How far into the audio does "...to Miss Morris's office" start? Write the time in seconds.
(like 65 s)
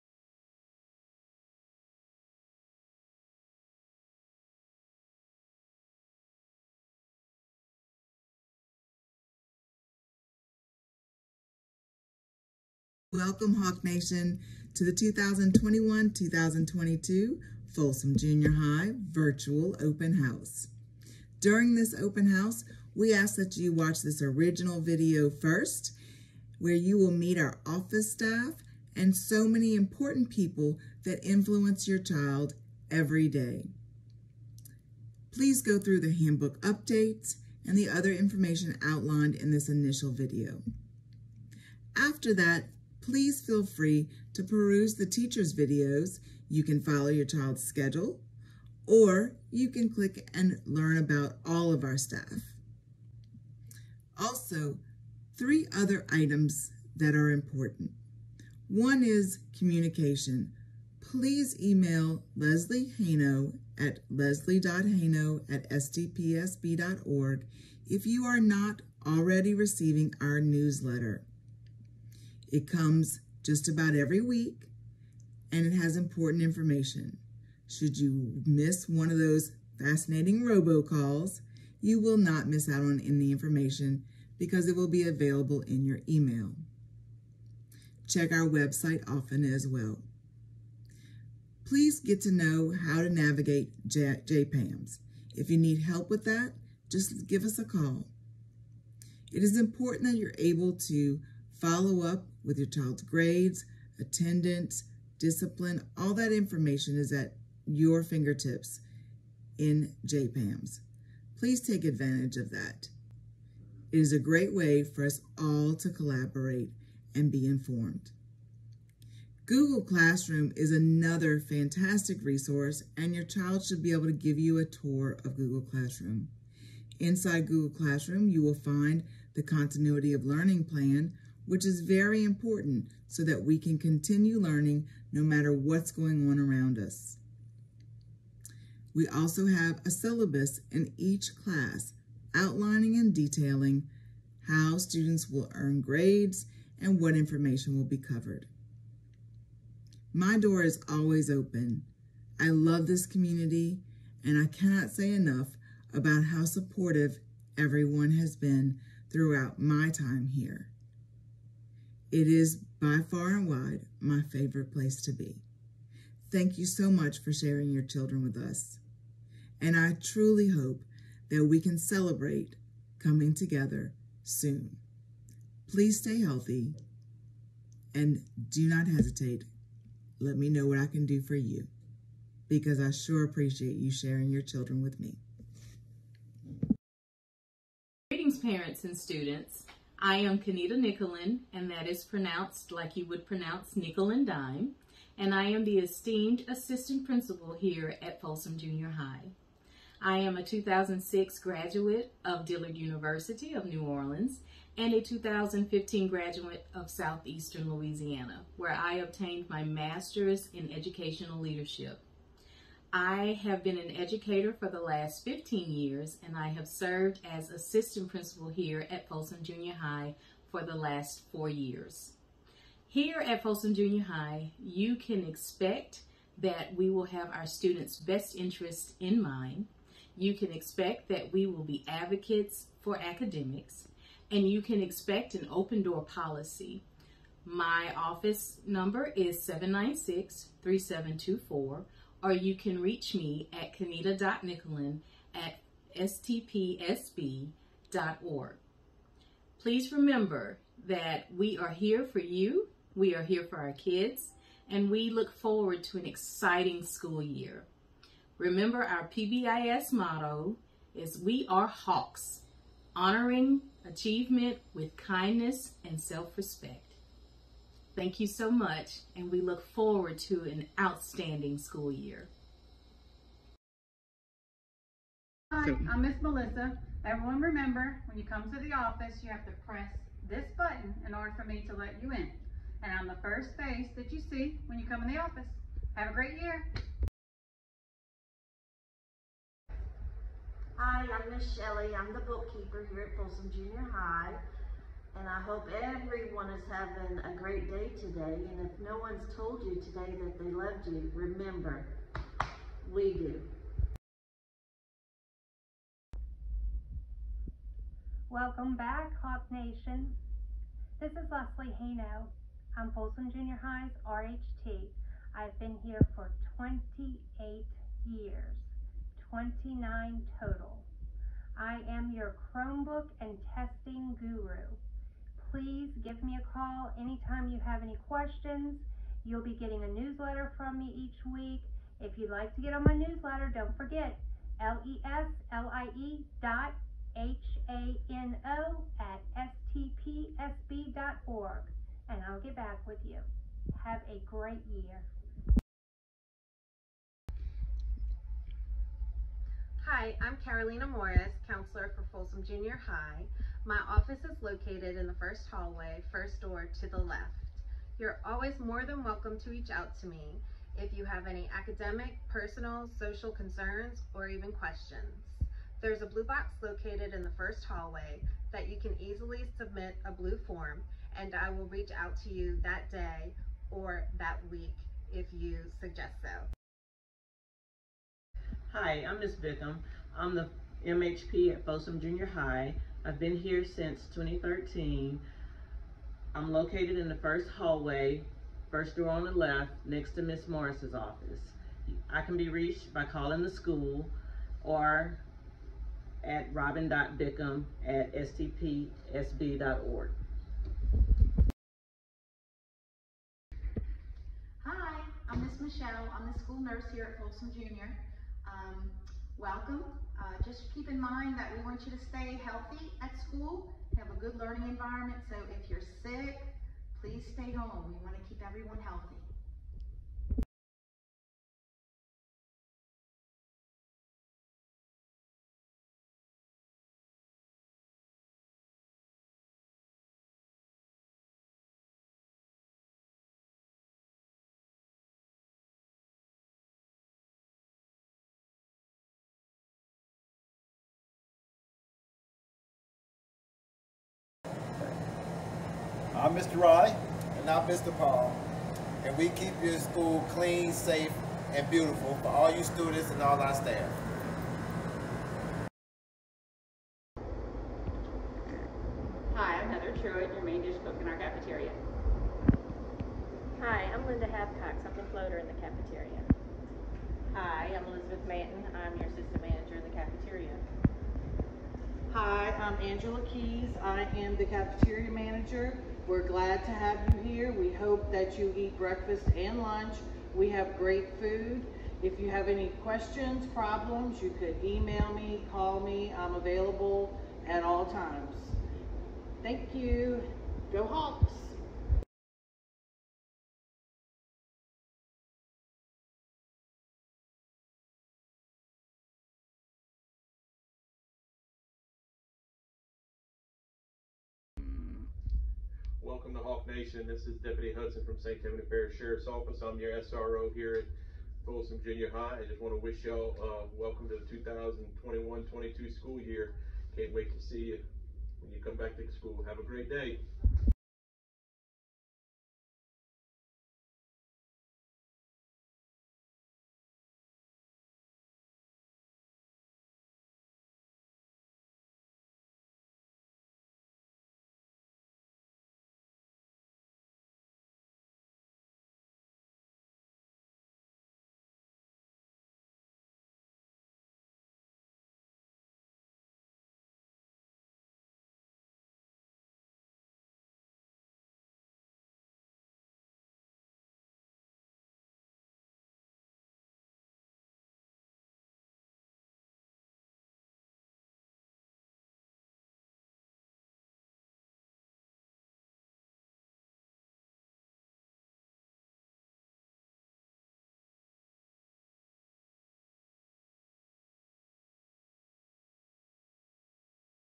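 390 s.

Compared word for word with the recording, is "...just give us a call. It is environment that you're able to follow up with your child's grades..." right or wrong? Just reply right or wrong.
wrong.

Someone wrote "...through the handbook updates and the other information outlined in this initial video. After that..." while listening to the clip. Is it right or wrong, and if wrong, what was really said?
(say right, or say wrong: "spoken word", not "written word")
right.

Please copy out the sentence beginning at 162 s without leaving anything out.
It is by far and wide my favorite place to be.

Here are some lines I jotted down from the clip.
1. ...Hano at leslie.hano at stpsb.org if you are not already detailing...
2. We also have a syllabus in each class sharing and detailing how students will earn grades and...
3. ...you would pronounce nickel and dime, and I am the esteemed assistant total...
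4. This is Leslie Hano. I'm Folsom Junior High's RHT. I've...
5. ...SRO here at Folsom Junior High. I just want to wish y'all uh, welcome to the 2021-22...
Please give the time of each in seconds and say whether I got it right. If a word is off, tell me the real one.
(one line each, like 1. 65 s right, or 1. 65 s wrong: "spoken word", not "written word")
1. 62 s wrong: "receiving", not "detailing"
2. 138 s wrong: "outlining", not "sharing"
3. 192 s wrong: "principal", not "total"
4. 311 s right
5. 510 s right.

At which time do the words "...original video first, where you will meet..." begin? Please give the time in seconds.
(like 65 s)
24 s.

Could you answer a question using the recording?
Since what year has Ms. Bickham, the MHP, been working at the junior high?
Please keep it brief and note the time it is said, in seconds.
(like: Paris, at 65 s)
2013, at 384 s.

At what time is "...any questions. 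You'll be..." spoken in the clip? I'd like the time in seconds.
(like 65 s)
327 s.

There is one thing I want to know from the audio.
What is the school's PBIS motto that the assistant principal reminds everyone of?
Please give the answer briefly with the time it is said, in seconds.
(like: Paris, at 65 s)
We Are Hawks, at 261 s.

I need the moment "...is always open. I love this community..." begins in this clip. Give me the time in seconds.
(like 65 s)
150 s.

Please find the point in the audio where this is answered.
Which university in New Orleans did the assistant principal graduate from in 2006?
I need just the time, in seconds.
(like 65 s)
202 s.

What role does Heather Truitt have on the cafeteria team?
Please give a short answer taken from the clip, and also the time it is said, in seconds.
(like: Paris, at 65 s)
Main dish cook, at 460 s.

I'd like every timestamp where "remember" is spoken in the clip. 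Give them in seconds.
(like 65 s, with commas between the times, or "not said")
249 s, 258 s, 277 s, 301 s.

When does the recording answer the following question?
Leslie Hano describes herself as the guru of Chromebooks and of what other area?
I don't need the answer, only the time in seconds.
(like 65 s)
323 s.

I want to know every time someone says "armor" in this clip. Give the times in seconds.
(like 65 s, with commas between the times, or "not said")
not said.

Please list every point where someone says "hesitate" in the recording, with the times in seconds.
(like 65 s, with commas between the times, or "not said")
178 s.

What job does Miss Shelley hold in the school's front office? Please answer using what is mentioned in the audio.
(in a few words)
Bookkeeper.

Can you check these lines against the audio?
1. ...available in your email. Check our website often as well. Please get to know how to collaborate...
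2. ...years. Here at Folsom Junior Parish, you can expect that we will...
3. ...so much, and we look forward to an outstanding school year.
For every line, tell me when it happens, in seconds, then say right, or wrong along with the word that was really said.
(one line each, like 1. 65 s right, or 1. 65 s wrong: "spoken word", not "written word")
1. 85 s wrong: "navigate", not "collaborate"
2. 221 s wrong: "High", not "Parish"
3. 268 s right.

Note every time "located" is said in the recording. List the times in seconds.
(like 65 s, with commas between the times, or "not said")
354 s, 366 s, 386 s.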